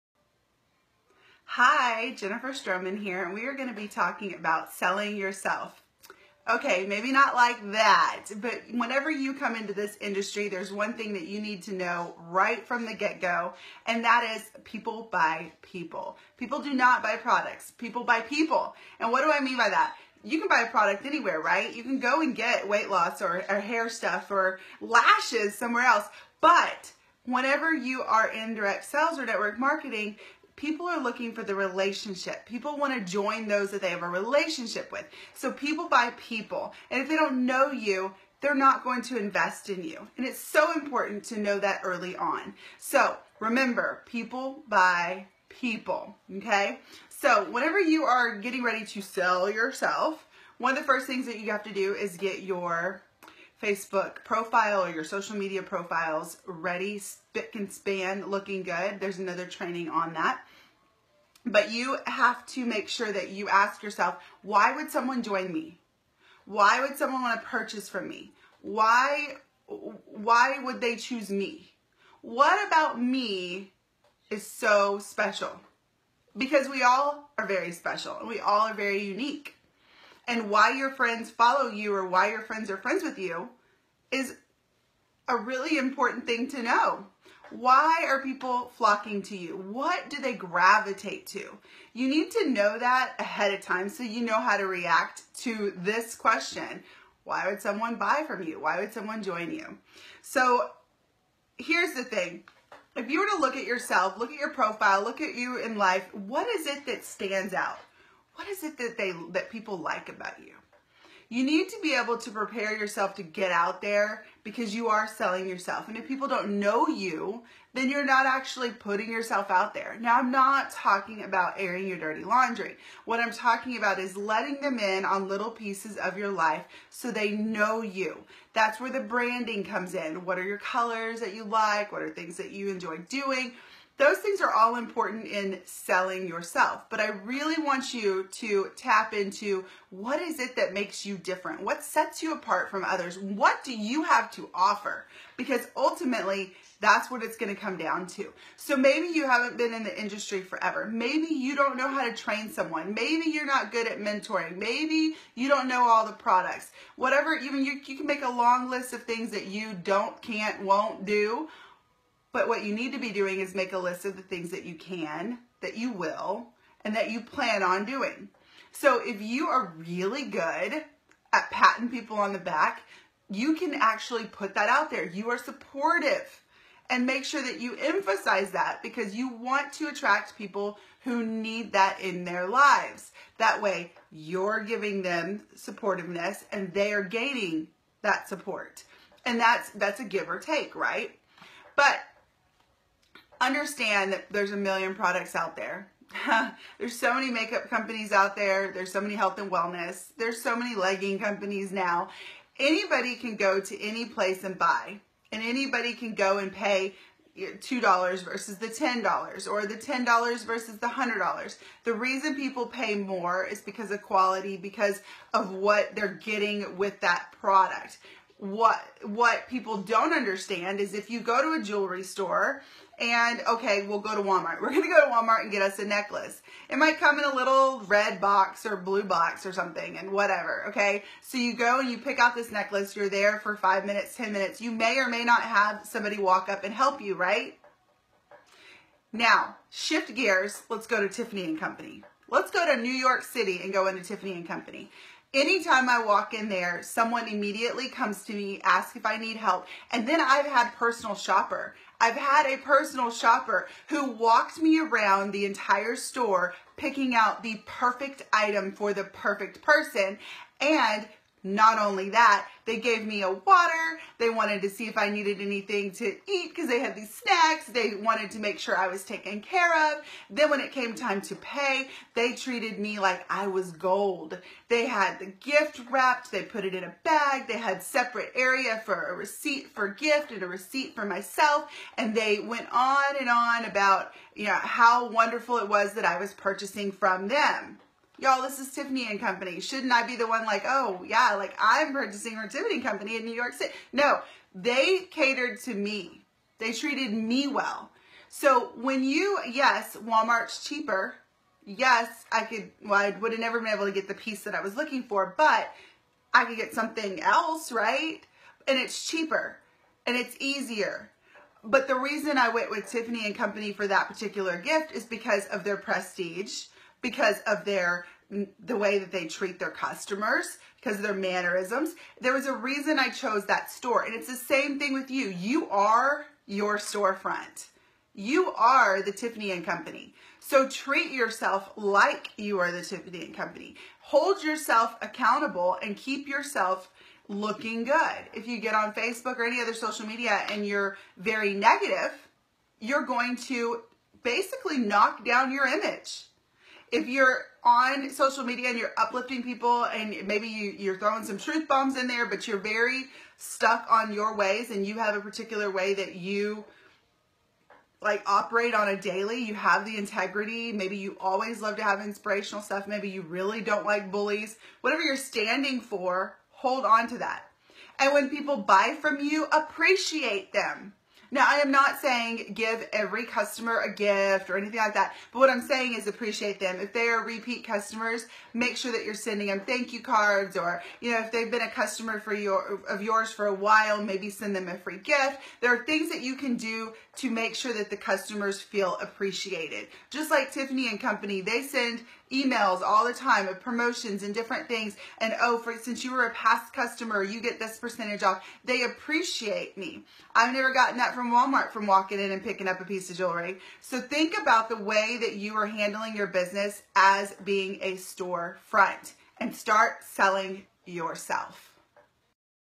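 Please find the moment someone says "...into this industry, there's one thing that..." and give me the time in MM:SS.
00:09.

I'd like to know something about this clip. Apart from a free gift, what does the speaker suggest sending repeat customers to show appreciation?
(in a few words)
Thank you cards.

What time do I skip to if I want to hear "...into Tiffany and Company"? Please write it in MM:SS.
04:03.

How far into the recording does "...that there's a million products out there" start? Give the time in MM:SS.
03:14.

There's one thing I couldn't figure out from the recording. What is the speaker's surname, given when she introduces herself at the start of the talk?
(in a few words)
Stroman.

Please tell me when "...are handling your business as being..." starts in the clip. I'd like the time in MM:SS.
06:45.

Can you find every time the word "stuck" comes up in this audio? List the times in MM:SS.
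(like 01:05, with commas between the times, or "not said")
05:53.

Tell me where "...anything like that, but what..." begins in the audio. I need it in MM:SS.
06:14.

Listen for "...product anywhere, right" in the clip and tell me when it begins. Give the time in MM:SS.
00:20.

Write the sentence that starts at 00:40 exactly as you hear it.
And it's so important to know that early on.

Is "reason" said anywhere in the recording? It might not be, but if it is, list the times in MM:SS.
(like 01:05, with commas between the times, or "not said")
03:31, 05:11, 05:22.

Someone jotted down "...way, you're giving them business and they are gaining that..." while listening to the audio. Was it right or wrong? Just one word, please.
wrong.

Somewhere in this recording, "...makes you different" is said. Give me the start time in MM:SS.
02:20.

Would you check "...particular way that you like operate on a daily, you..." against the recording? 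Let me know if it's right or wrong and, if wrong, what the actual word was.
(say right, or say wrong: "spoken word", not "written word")
right.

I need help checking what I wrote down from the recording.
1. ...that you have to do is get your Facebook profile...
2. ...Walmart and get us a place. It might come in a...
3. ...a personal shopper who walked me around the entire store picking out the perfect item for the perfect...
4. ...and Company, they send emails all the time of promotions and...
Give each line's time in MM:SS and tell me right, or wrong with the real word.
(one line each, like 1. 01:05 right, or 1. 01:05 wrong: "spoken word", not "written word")
1. 00:51 right
2. 03:45 wrong: "necklace", not "place"
3. 04:12 right
4. 06:30 right.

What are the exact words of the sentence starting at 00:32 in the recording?
People want to join those that they have a relationship with.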